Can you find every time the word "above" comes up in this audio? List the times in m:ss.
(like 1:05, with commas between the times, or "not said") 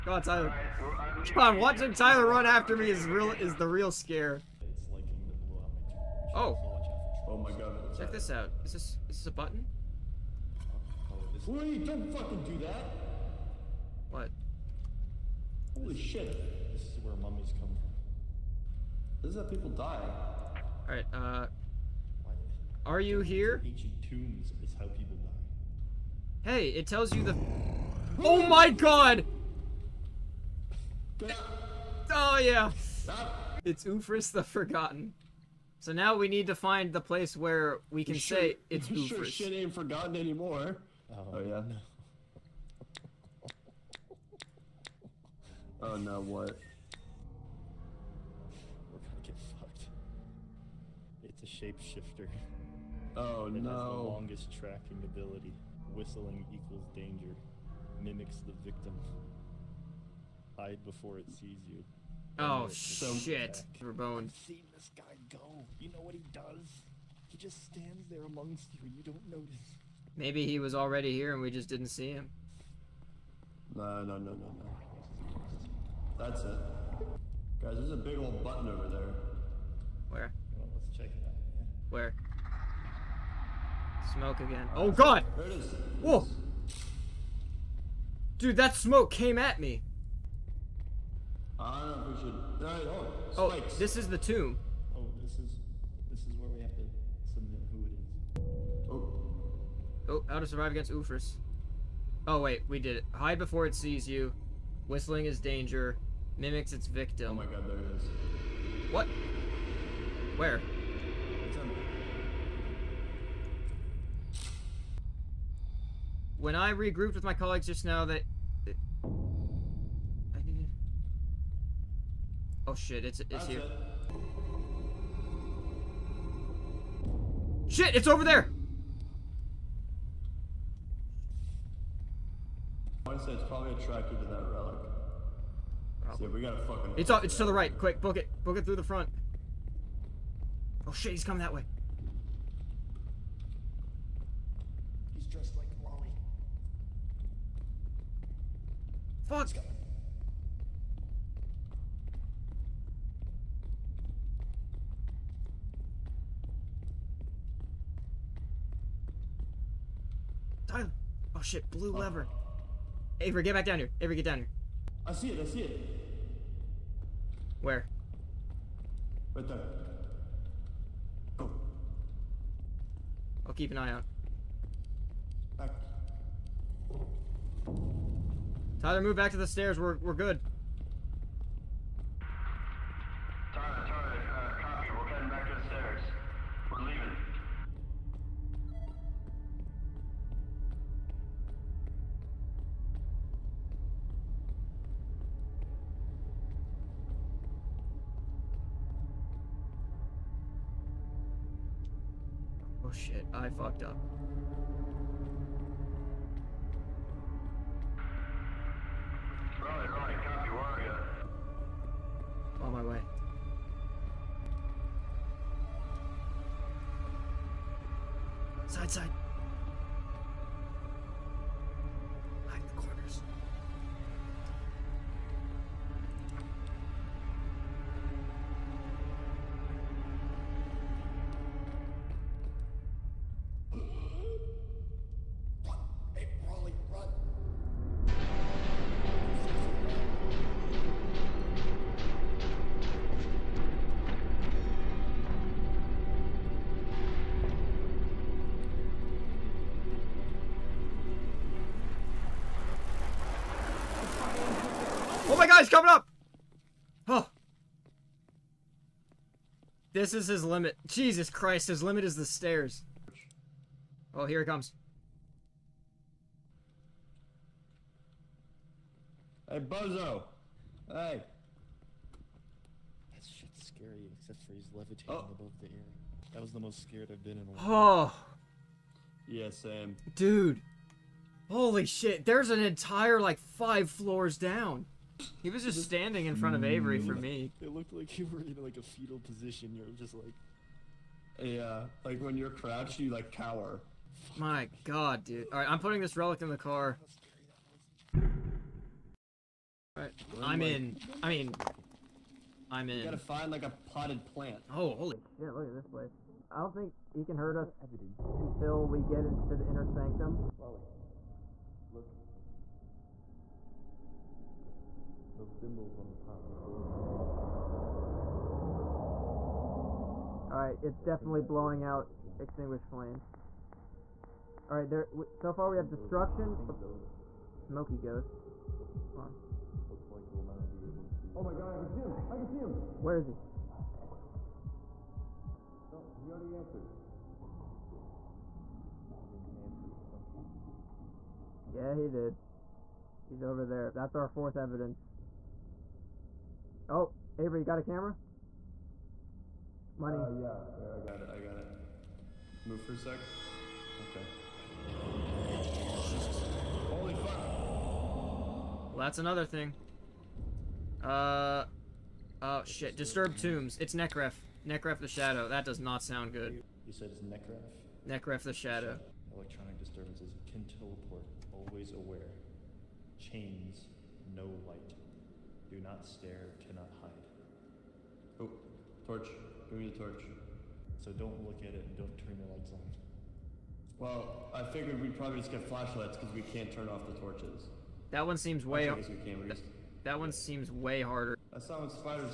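4:35.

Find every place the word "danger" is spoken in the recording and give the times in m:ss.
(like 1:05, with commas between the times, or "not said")
0:56, 1:45.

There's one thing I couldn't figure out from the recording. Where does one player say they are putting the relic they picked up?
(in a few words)
In the car.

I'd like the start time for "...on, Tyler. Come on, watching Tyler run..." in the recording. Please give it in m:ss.
0:00.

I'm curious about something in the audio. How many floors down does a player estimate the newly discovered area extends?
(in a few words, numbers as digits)
5.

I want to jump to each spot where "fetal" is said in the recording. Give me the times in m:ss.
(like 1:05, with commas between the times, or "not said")
4:48.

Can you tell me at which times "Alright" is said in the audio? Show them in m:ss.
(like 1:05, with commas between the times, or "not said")
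0:20, 5:20, 5:24.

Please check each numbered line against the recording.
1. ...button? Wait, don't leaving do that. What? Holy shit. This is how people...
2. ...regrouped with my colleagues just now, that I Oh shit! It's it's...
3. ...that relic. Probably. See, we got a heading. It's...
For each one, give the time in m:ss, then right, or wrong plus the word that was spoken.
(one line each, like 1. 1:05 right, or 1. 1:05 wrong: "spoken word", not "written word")
1. 0:09 wrong: "fucking", not "leaving"
2. 1:56 right
3. 2:14 wrong: "fucking", not "heading".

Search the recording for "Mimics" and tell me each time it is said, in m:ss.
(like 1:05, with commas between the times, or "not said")
0:58, 1:46.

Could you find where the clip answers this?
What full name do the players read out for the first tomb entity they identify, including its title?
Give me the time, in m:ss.
0:33.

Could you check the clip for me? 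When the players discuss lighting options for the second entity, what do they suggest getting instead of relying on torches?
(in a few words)
Flashlights.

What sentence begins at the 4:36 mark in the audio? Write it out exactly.
That was the most scared I've been in a while.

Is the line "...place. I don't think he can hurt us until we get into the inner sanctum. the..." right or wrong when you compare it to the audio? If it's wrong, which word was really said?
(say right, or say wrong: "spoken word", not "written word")
right.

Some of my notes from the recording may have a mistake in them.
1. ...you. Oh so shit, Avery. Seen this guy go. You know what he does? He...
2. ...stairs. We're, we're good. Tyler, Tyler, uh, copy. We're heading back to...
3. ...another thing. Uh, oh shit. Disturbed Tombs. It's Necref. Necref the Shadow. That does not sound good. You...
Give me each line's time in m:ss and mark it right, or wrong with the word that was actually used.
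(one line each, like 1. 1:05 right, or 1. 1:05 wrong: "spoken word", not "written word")
1. 1:01 wrong: "Rabone", not "Avery"
2. 2:59 right
3. 5:59 right.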